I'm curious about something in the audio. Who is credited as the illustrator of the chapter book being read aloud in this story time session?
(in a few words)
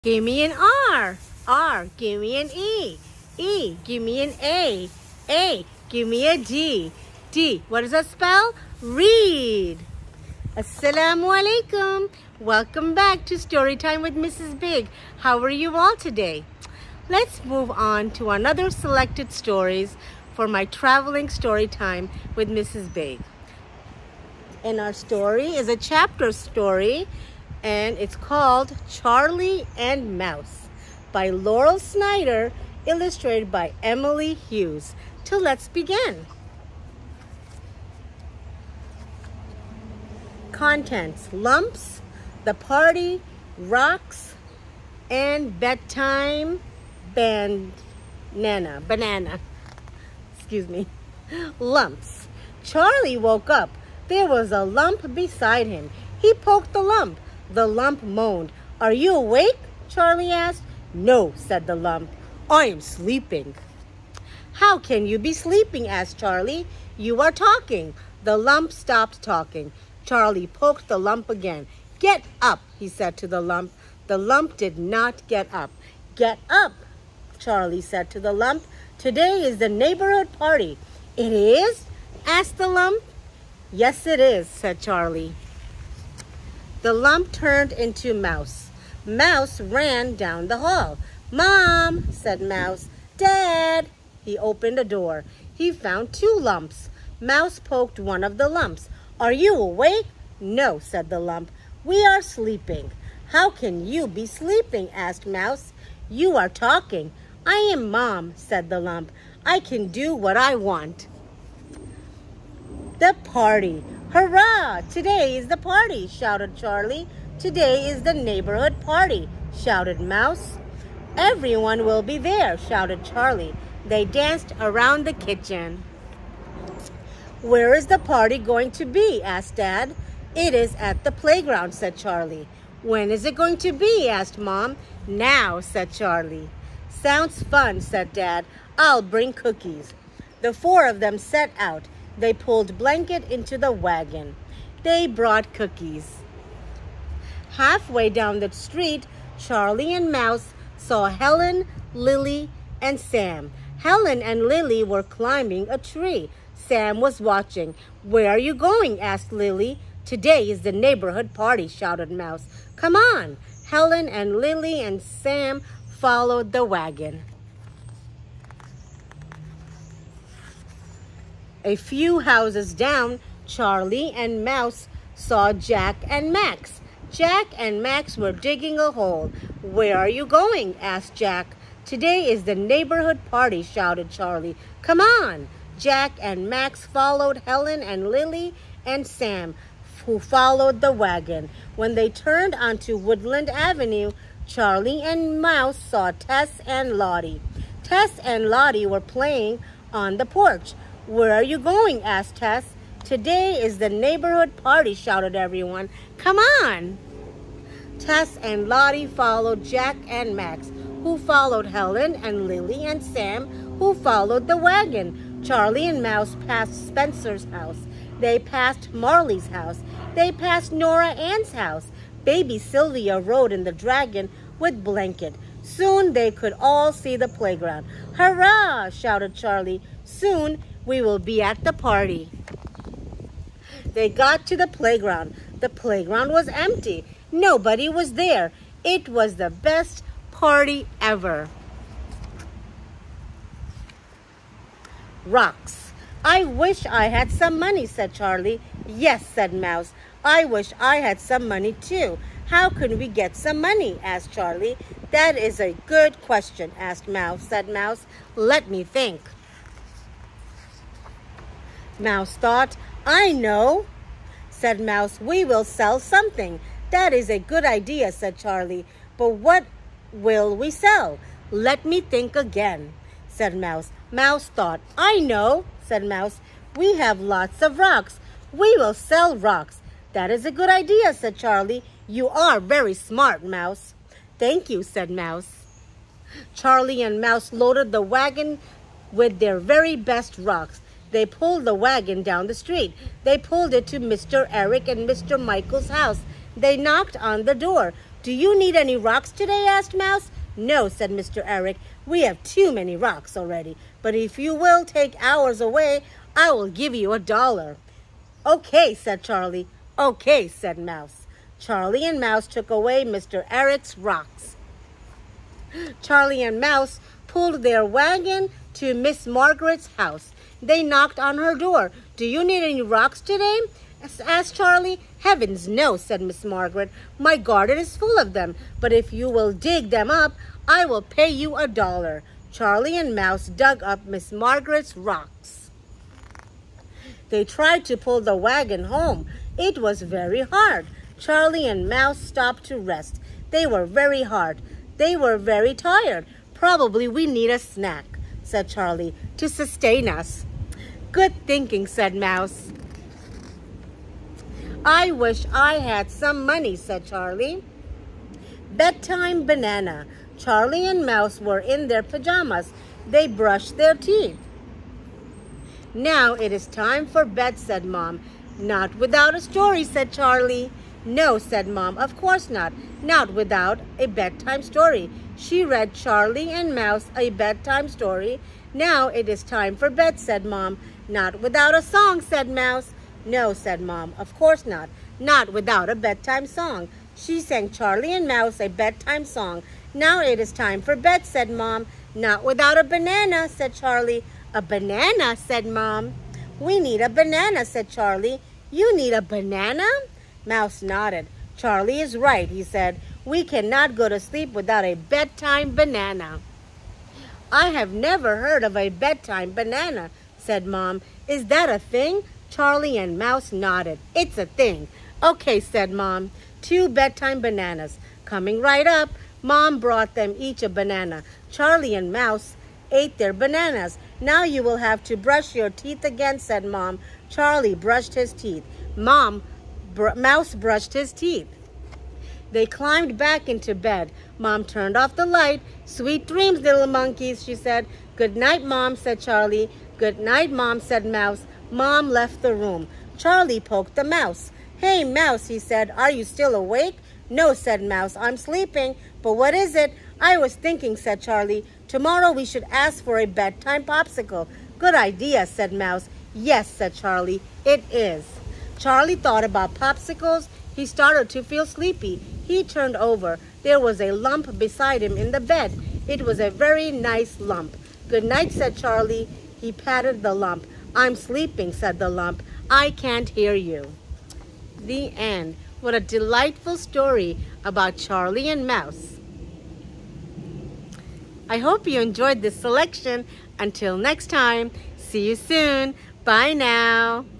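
Emily Hughes.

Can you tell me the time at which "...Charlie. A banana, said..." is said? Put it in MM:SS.
06:33.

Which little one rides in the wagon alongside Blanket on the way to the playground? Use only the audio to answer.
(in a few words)
Baby Sylvia.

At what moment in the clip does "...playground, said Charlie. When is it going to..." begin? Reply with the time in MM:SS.
02:11.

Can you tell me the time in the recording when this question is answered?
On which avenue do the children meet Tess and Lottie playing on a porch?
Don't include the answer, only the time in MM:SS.
03:12.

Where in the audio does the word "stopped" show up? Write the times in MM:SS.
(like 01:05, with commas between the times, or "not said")
01:08, 05:42.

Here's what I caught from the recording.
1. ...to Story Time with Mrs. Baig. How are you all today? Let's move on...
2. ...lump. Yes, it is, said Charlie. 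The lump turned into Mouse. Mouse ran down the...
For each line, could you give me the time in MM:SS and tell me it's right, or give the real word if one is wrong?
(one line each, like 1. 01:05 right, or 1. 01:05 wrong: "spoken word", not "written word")
1. 00:13 right
2. 01:22 right.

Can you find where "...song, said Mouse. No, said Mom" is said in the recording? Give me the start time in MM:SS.
06:21.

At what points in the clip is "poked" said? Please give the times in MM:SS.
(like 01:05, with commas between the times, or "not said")
00:56, 01:10, 01:37, 07:23.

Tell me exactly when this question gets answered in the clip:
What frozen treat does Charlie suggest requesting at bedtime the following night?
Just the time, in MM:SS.
07:33.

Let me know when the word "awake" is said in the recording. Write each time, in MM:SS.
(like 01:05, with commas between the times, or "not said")
00:59, 01:39, 07:26.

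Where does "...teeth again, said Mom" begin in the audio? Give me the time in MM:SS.
07:05.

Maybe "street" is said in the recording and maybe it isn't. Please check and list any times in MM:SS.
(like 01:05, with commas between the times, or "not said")
02:28, 04:52.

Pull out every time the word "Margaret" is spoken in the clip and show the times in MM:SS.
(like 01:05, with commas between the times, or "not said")
05:19, 05:26, 05:34.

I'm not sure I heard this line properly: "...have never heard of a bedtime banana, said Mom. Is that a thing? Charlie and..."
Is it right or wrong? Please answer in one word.
right.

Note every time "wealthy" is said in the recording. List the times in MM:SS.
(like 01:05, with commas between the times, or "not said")
not said.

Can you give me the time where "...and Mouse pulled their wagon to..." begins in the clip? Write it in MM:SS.
05:16.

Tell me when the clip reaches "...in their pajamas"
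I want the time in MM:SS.
06:01.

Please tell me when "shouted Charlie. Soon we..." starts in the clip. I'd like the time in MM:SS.
03:48.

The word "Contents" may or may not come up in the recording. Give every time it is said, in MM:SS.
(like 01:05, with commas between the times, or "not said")
00:40.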